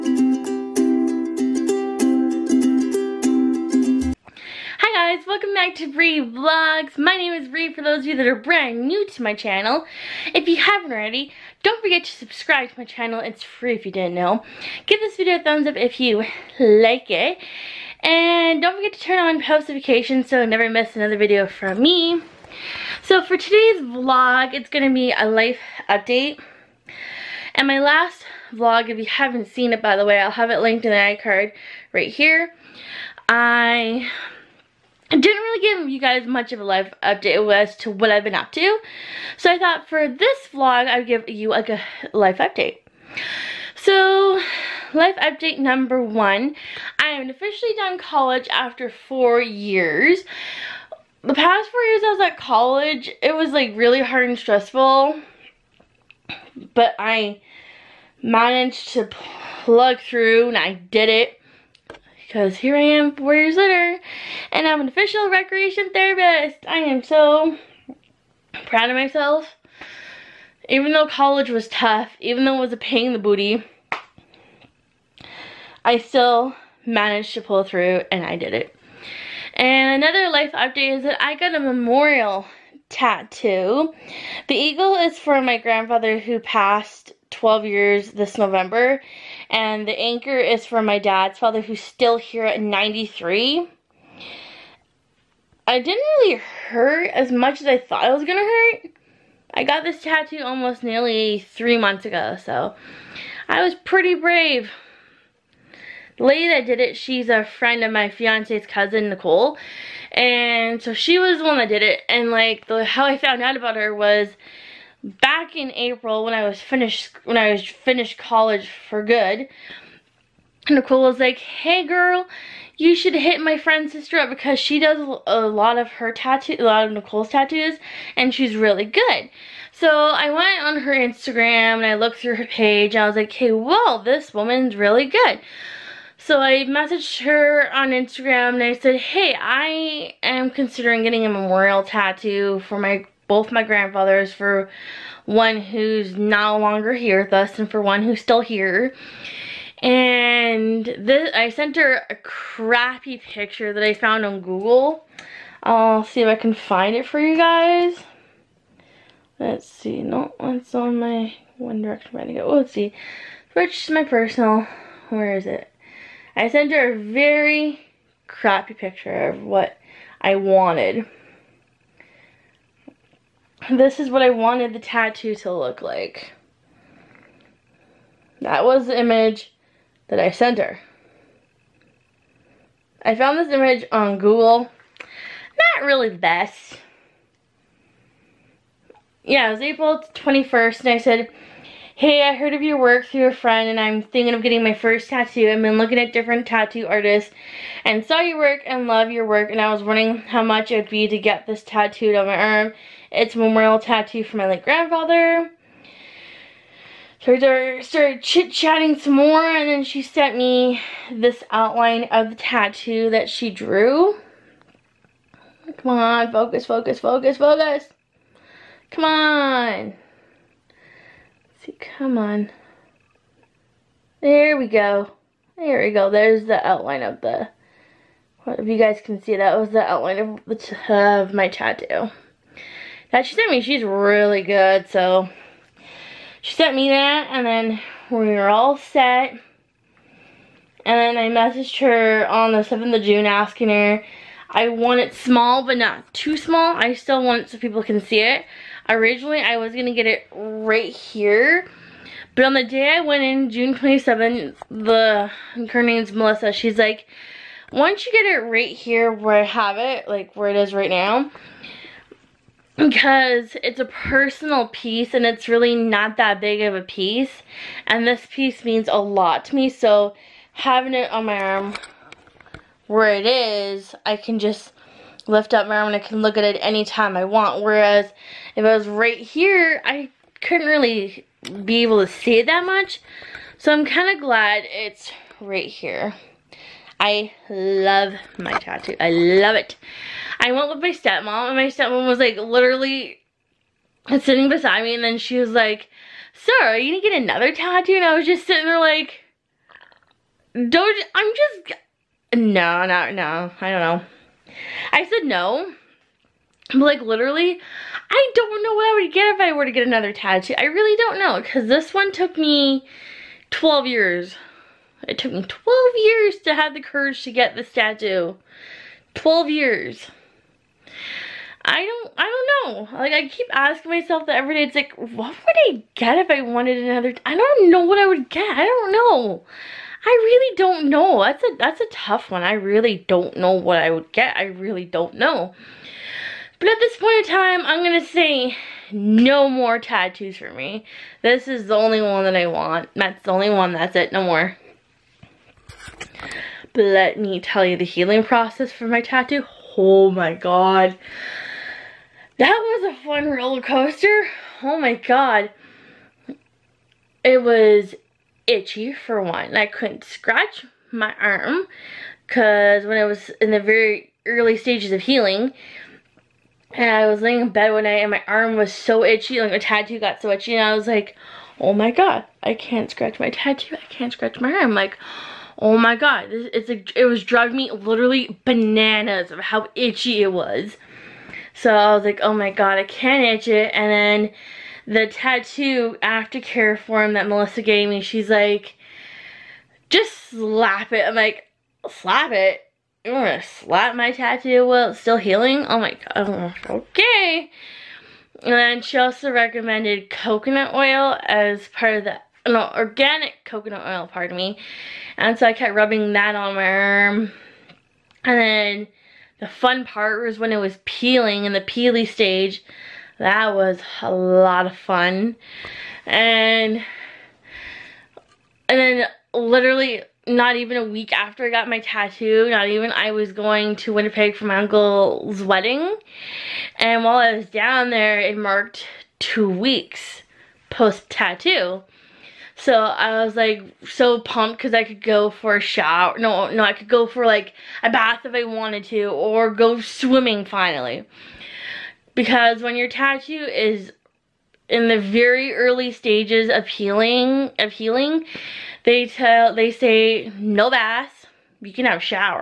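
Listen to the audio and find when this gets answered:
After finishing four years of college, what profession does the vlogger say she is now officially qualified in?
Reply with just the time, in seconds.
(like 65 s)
65 s.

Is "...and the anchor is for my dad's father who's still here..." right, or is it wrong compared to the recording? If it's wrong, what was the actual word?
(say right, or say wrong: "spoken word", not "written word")
right.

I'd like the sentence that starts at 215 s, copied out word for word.
Come on, focus, focus, focus, focus.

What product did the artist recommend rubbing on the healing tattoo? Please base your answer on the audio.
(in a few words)
organic coconut oil.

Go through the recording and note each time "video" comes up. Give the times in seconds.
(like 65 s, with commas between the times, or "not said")
15 s, 21 s.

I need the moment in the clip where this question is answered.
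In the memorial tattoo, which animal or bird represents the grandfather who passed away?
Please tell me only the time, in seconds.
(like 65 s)
84 s.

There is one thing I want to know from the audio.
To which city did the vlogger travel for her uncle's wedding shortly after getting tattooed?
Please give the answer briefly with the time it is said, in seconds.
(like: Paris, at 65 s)
Winnipeg, at 423 s.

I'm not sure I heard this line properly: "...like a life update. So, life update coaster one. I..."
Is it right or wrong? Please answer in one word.
wrong.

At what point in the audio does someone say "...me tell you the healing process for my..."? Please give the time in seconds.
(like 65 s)
347 s.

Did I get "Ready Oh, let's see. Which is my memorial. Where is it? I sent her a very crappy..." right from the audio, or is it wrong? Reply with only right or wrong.
wrong.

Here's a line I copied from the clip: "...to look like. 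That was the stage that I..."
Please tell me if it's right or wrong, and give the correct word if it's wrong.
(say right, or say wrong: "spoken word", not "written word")
wrong: "image", not "stage".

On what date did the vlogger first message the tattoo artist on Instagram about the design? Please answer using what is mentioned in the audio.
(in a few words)
April 21.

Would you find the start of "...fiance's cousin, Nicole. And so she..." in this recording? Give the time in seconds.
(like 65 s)
108 s.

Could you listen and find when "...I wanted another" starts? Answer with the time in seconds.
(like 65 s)
326 s.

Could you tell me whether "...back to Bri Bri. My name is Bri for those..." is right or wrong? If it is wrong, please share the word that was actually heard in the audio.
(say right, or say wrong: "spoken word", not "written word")
wrong: "Vlogs", not "Bri".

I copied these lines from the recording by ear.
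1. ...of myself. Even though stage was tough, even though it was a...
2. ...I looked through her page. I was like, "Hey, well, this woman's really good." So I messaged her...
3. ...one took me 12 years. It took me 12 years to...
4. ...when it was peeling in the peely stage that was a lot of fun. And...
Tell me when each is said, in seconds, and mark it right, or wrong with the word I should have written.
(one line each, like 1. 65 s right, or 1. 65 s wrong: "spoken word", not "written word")
1. 68 s wrong: "college", not "stage"
2. 131 s right
3. 311 s right
4. 410 s right.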